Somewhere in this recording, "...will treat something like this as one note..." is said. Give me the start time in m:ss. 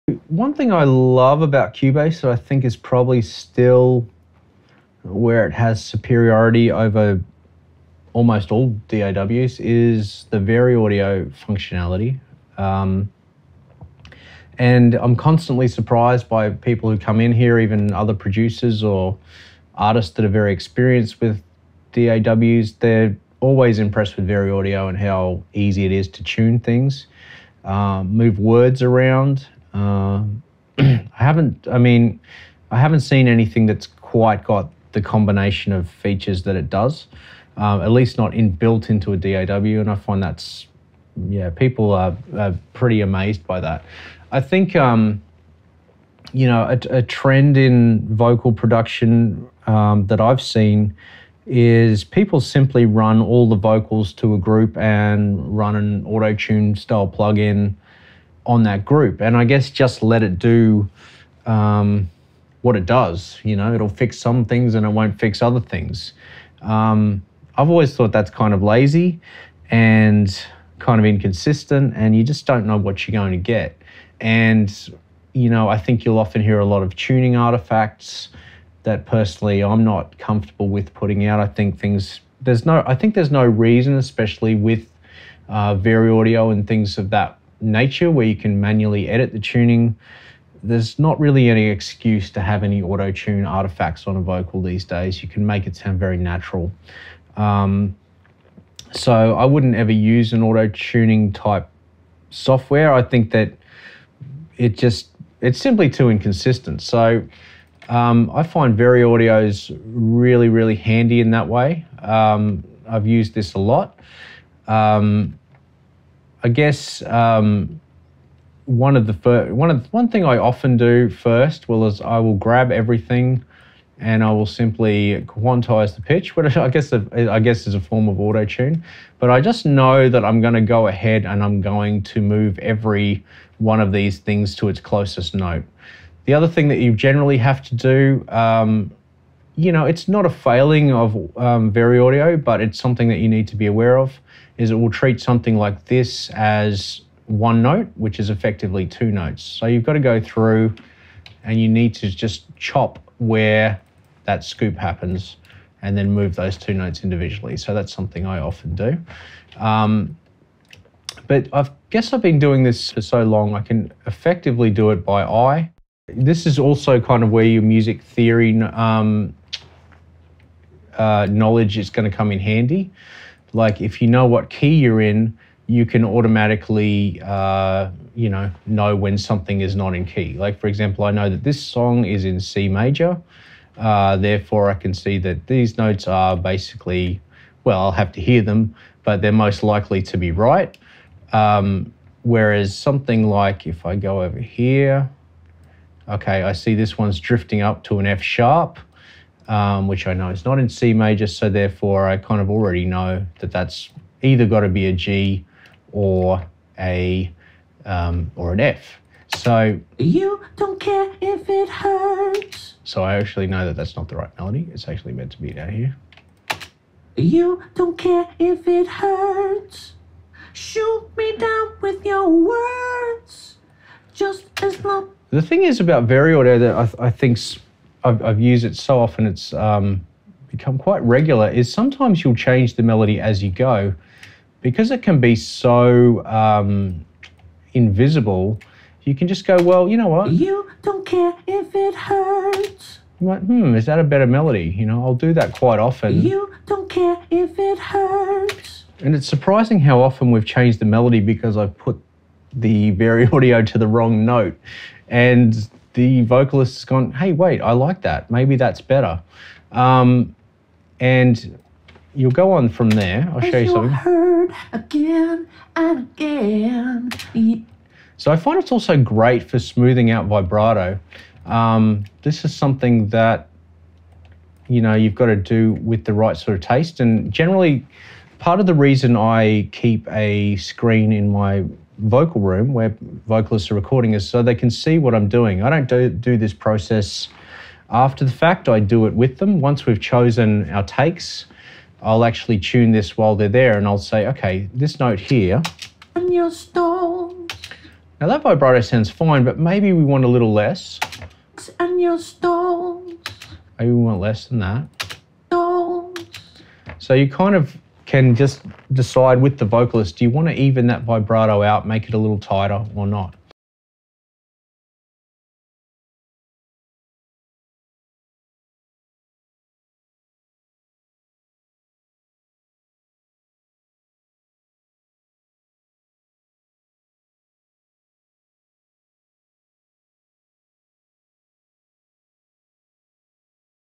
2:24.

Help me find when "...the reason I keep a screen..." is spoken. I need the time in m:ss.
4:38.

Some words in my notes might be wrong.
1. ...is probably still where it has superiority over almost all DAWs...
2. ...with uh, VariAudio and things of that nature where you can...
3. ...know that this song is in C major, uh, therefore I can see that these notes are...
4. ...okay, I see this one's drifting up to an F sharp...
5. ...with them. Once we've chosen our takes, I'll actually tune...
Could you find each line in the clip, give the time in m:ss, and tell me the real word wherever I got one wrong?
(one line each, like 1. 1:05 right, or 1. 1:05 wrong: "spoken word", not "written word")
1. 0:02 right
2. 1:24 right
3. 3:01 right
4. 3:16 right
5. 4:49 right.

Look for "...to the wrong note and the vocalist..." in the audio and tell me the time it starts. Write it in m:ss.
4:13.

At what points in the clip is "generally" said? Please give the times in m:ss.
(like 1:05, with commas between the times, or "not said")
2:16, 4:37.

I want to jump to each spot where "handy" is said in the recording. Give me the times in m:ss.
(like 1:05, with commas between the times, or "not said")
1:50, 2:52.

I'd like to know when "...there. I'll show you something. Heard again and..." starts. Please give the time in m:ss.
4:22.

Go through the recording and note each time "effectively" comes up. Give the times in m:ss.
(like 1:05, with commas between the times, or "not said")
2:28, 2:44.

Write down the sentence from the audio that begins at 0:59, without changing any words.
And I guess just let it do um, what it does.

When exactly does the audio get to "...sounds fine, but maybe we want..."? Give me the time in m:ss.
4:58.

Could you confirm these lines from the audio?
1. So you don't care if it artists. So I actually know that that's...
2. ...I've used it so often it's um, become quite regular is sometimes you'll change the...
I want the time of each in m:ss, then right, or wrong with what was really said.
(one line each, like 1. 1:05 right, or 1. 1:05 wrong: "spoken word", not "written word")
1. 3:29 wrong: "hurts", not "artists"
2. 3:48 right.